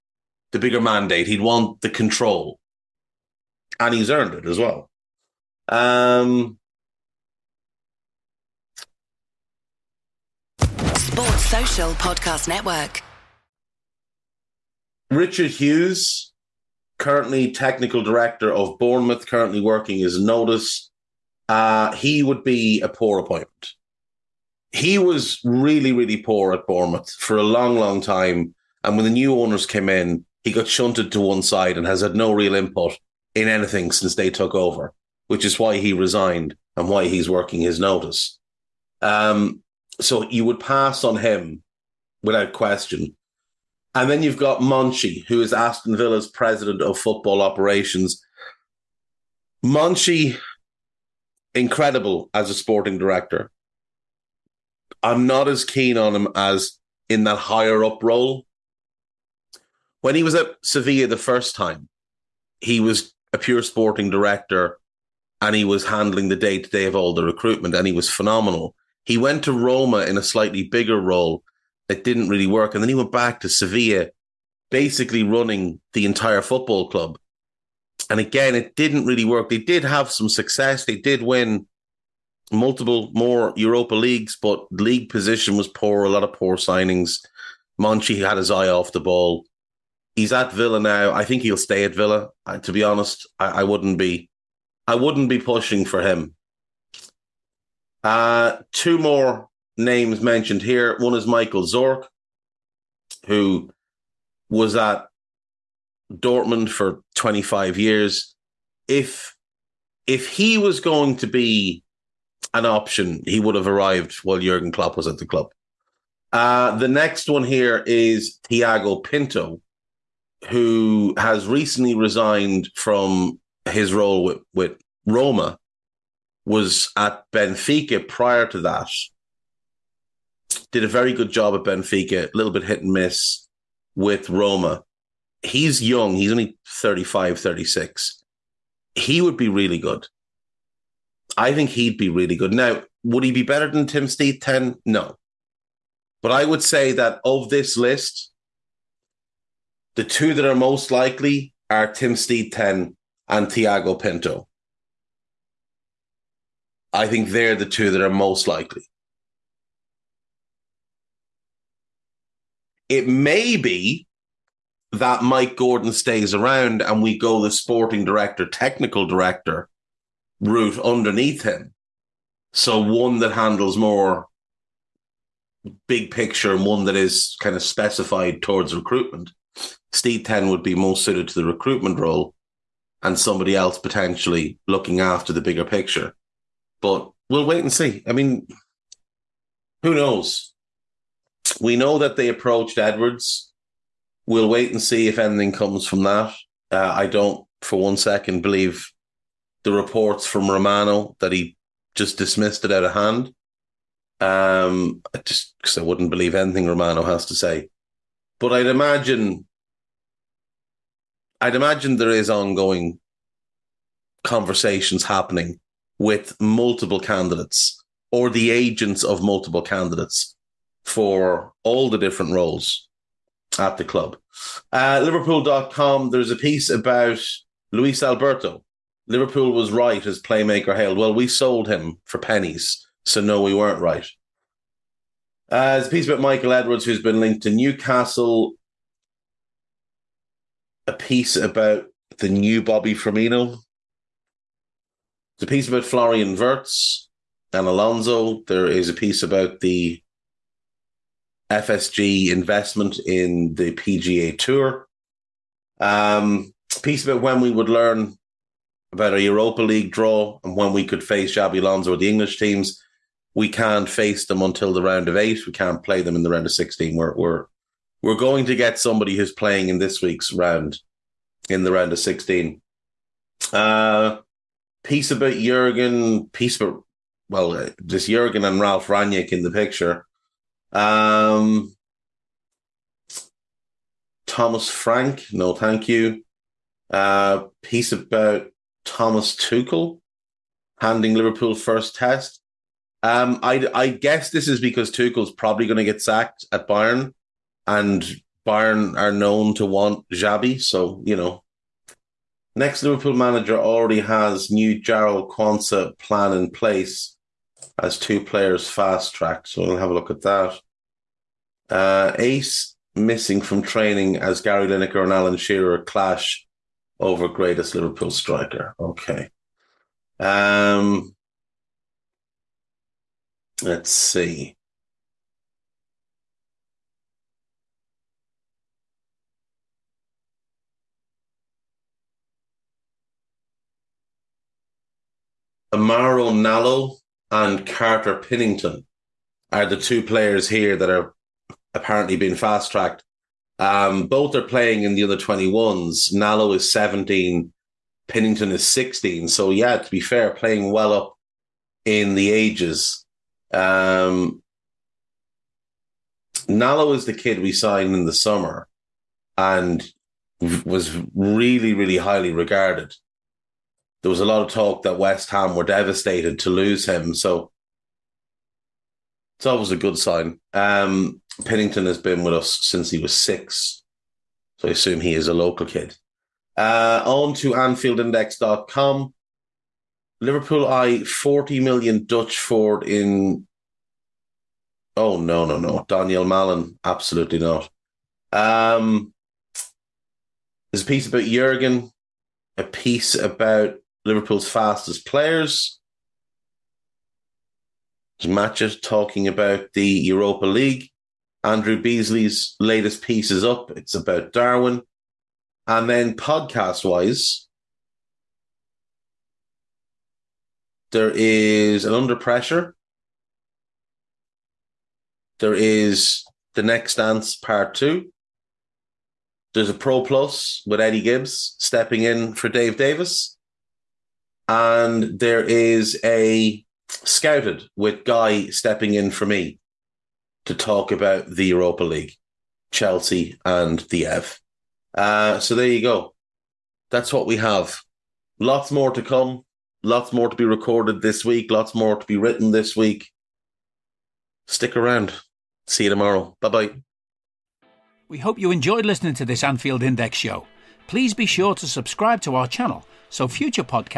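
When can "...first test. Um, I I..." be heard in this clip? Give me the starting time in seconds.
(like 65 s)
291 s.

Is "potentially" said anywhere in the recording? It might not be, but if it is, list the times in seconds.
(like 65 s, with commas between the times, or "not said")
183 s.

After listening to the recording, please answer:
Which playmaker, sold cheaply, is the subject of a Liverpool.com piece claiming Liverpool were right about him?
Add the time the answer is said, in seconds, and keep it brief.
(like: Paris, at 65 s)
Luis Alberto, at 227 s.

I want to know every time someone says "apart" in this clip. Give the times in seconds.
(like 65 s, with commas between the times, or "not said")
not said.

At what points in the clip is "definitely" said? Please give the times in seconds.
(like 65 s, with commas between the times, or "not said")
not said.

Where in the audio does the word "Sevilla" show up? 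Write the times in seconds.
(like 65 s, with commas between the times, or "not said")
60 s, 73 s.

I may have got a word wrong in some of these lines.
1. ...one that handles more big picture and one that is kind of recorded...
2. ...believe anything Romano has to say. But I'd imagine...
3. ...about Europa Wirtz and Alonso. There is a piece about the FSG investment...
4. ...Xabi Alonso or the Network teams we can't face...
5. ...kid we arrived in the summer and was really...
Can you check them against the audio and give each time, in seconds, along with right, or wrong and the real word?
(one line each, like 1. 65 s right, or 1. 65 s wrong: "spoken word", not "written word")
1. 172 s wrong: "specified", not "recorded"
2. 206 s right
3. 245 s wrong: "Florian", not "Europa"
4. 261 s wrong: "English", not "Network"
5. 357 s wrong: "signed", not "arrived".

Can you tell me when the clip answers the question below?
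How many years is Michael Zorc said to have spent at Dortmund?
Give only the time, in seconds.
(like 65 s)
107 s.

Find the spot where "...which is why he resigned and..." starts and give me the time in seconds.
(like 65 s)
35 s.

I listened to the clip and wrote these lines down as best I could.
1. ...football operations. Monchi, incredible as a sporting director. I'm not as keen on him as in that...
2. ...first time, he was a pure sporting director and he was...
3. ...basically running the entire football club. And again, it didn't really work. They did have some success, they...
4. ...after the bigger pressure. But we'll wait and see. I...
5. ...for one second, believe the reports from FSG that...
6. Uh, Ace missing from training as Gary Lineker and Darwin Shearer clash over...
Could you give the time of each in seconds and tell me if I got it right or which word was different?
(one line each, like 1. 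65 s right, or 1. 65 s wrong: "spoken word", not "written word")
1. 46 s right
2. 61 s right
3. 74 s right
4. 185 s wrong: "picture", not "pressure"
5. 197 s wrong: "Romano", not "FSG"
6. 311 s wrong: "Alan", not "Darwin".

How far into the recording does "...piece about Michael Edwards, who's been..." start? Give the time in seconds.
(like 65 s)
235 s.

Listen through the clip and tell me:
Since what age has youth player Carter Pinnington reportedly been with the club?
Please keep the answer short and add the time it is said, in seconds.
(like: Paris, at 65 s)
6, at 372 s.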